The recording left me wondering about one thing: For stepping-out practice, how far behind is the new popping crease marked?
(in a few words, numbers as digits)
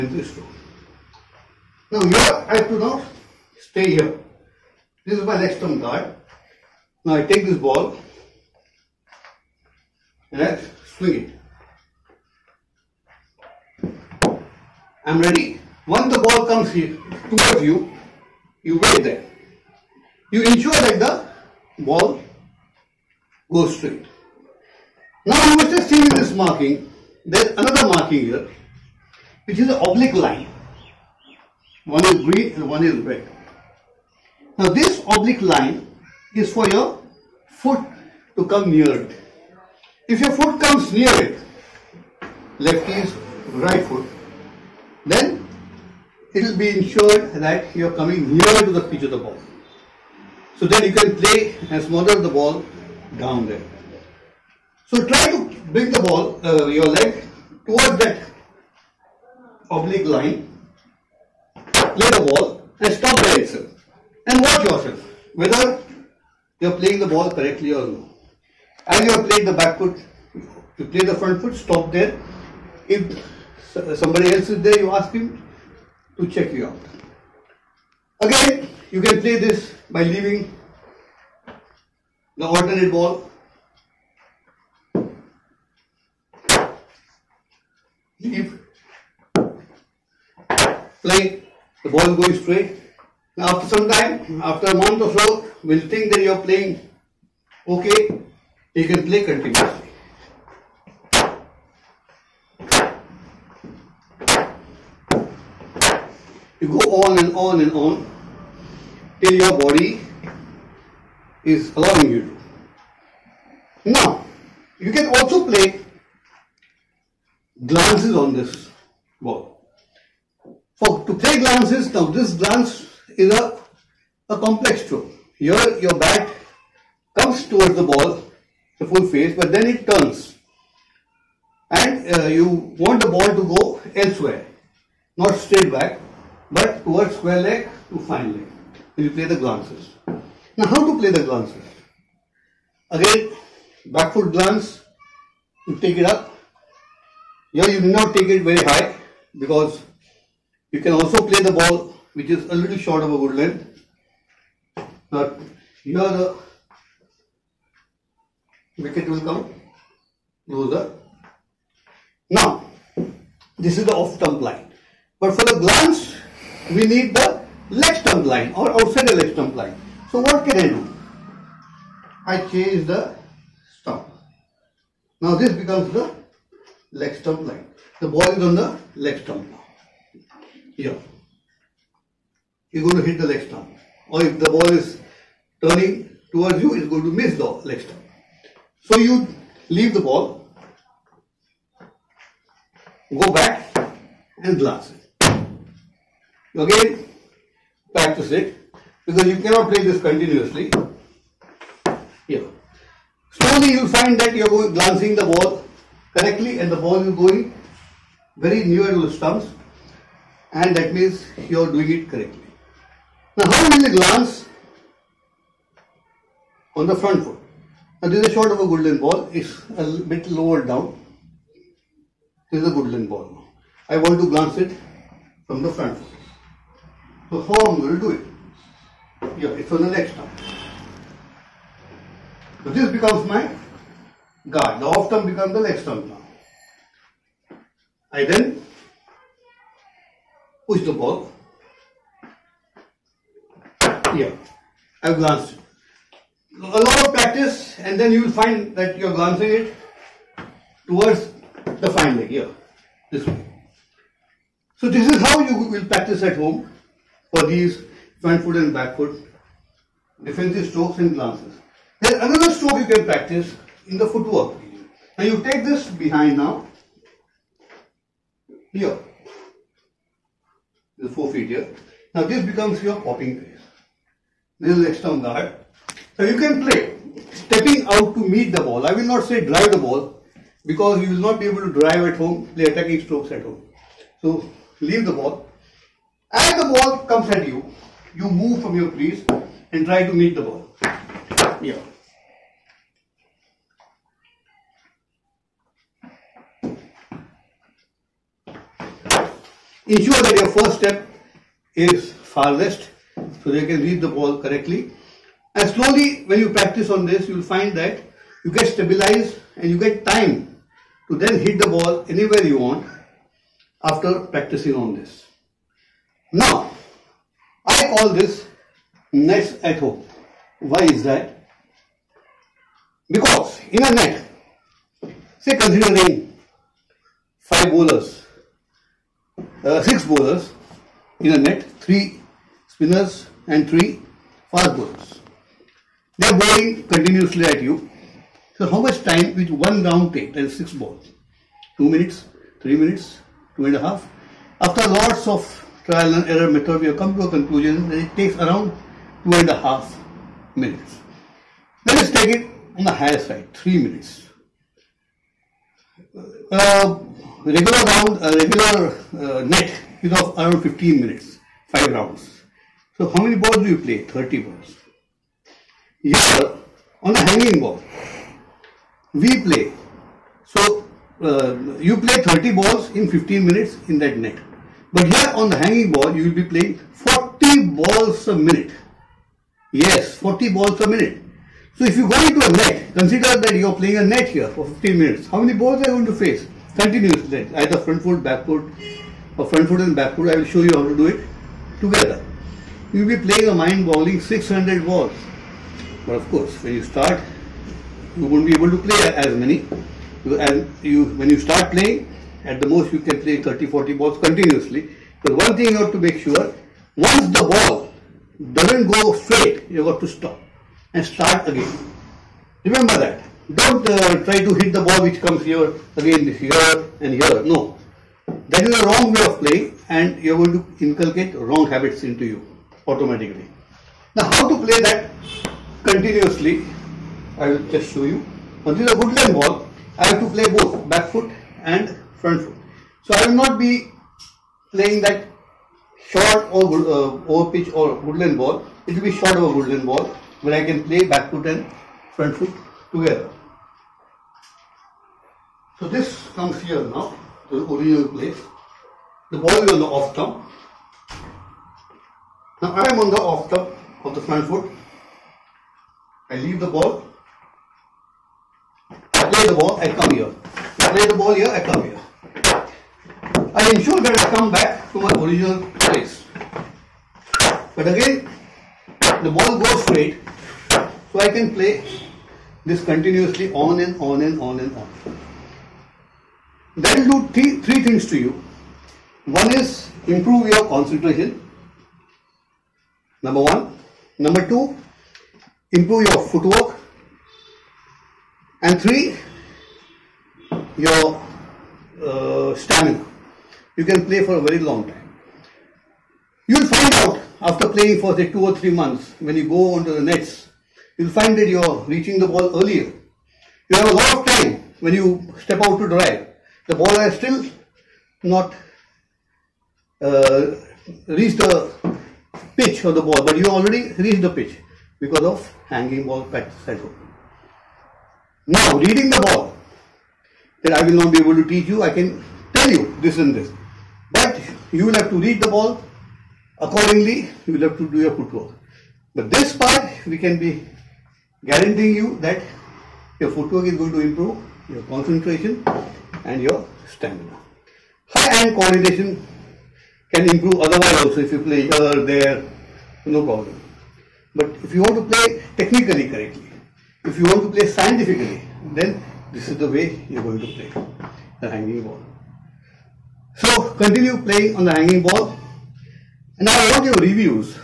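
four feet.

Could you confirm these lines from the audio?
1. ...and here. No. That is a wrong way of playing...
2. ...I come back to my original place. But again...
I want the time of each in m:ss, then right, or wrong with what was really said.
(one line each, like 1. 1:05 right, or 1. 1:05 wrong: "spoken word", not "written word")
1. 6:57 right
2. 7:44 right.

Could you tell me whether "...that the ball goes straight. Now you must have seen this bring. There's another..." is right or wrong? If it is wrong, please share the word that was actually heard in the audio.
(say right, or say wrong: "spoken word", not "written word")
wrong: "marking", not "bring".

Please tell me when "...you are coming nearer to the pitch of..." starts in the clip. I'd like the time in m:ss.
0:47.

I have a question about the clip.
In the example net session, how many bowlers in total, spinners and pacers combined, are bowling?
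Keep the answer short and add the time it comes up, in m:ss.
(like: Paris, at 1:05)
6, at 5:29.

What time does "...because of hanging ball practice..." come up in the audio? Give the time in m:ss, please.
8:34.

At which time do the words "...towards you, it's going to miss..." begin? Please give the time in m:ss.
3:06.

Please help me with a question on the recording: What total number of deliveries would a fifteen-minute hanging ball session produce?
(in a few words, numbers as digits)
600.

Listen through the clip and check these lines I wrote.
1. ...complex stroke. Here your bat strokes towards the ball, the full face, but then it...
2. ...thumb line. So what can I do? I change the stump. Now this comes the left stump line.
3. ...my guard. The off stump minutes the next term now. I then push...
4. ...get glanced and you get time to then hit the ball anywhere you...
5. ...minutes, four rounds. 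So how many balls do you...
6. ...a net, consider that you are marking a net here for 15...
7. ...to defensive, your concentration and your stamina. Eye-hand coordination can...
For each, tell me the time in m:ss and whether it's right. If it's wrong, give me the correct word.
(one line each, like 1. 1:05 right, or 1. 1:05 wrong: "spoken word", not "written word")
1. 2:04 wrong: "comes", not "strokes"
2. 2:49 wrong: "becomes", not "comes"
3. 3:53 wrong: "becomes", not "minutes"
4. 5:08 wrong: "stabilized", not "glanced"
5. 6:01 wrong: "five", not "four"
6. 6:22 wrong: "playing", not "marking"
7. 8:53 wrong: "improve", not "defensive".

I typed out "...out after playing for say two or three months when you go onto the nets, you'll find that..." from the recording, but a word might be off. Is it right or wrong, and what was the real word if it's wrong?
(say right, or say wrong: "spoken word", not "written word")
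right.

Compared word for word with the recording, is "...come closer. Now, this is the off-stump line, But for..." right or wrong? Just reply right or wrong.
right.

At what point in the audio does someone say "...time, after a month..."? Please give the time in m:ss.
1:33.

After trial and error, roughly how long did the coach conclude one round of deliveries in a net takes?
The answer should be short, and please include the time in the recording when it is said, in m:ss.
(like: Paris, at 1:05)
two and a half minutes, at 5:49.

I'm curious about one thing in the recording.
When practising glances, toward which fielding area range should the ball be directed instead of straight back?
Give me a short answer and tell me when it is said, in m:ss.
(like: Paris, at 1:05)
square leg to fine leg, at 2:17.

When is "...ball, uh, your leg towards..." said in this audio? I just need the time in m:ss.
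0:56.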